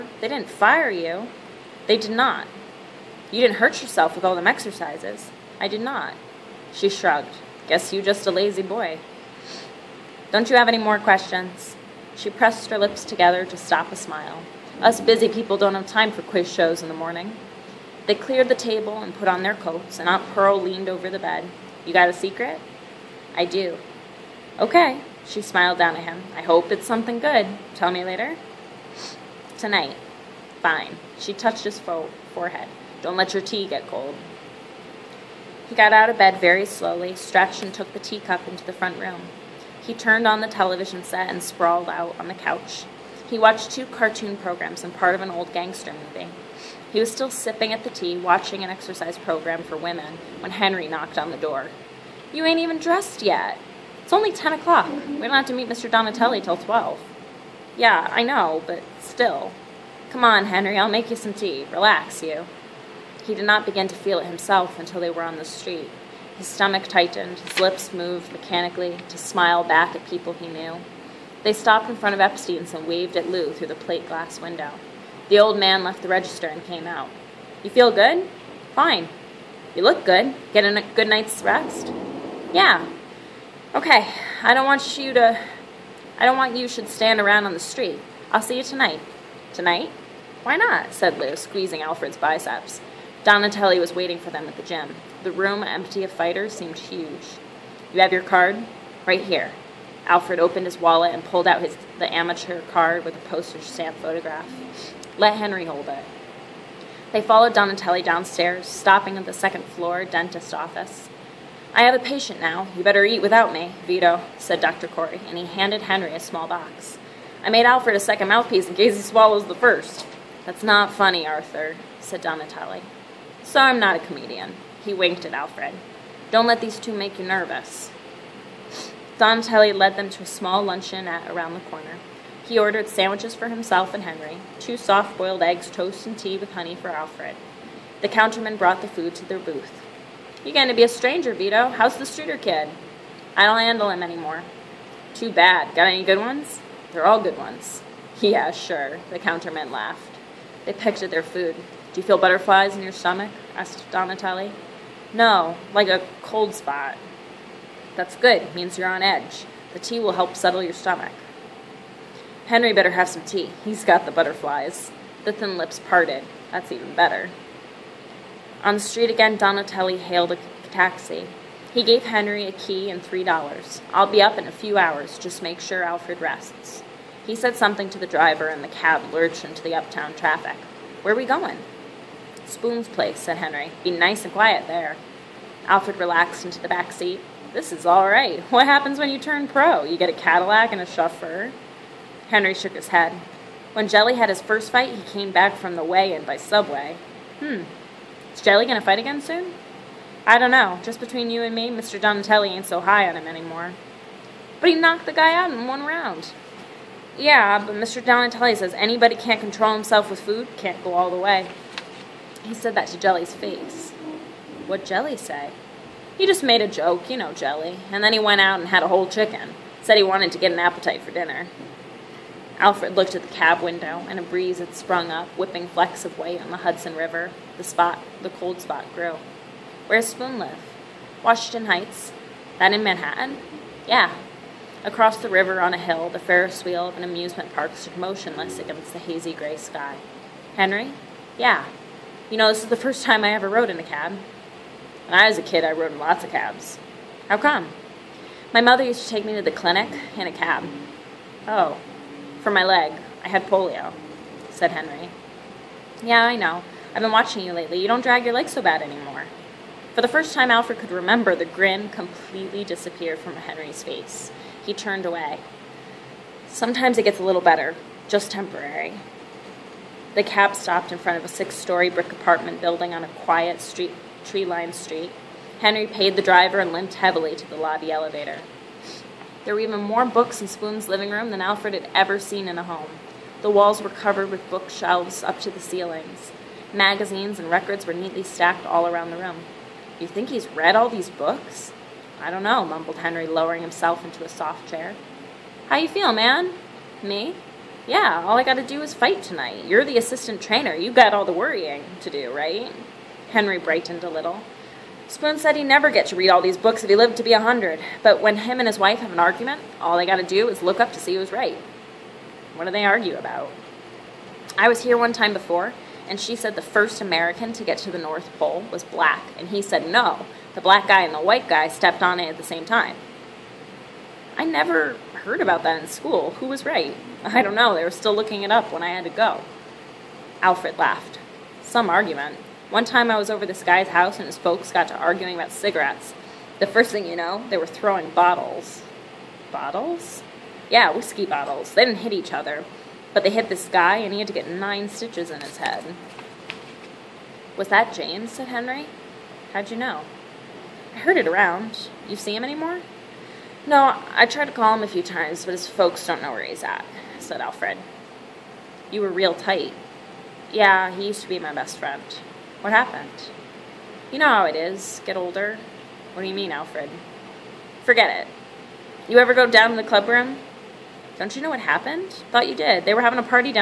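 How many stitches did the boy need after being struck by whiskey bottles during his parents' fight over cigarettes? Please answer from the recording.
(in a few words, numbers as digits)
9.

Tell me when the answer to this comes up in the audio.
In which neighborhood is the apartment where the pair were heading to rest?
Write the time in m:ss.
3:51.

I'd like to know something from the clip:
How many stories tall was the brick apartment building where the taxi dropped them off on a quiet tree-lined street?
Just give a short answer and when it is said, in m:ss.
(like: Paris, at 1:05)
6, at 4:31.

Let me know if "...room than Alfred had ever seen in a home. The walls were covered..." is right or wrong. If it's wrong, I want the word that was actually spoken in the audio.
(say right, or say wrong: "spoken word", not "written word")
right.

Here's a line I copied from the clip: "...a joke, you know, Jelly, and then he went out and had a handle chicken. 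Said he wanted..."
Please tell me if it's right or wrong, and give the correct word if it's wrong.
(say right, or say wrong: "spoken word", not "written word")
wrong: "whole", not "handle".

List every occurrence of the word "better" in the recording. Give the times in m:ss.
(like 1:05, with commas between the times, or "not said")
1:52, 2:42, 2:46, 4:27.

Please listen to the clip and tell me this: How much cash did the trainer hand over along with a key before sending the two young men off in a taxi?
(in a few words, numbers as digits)
$3.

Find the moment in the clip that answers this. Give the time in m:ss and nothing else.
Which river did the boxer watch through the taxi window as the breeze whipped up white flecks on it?
3:46.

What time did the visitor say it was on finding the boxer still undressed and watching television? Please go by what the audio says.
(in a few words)
10 o'clock.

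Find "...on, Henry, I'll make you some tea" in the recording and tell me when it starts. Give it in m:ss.
1:00.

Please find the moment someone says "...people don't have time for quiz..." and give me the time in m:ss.
0:15.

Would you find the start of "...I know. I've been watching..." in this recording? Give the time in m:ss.
4:16.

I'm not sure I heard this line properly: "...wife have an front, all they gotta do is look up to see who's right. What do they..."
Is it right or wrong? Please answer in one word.
wrong.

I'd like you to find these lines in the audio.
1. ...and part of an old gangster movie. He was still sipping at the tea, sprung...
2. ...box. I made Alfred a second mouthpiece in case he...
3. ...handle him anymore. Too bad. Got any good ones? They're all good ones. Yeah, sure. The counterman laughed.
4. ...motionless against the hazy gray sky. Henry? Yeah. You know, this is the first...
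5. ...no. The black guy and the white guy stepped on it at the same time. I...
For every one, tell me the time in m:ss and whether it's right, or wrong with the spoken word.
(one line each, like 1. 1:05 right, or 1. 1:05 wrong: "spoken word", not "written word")
1. 0:44 wrong: "watching", not "sprung"
2. 1:56 right
3. 2:23 right
4. 3:57 right
5. 5:19 right.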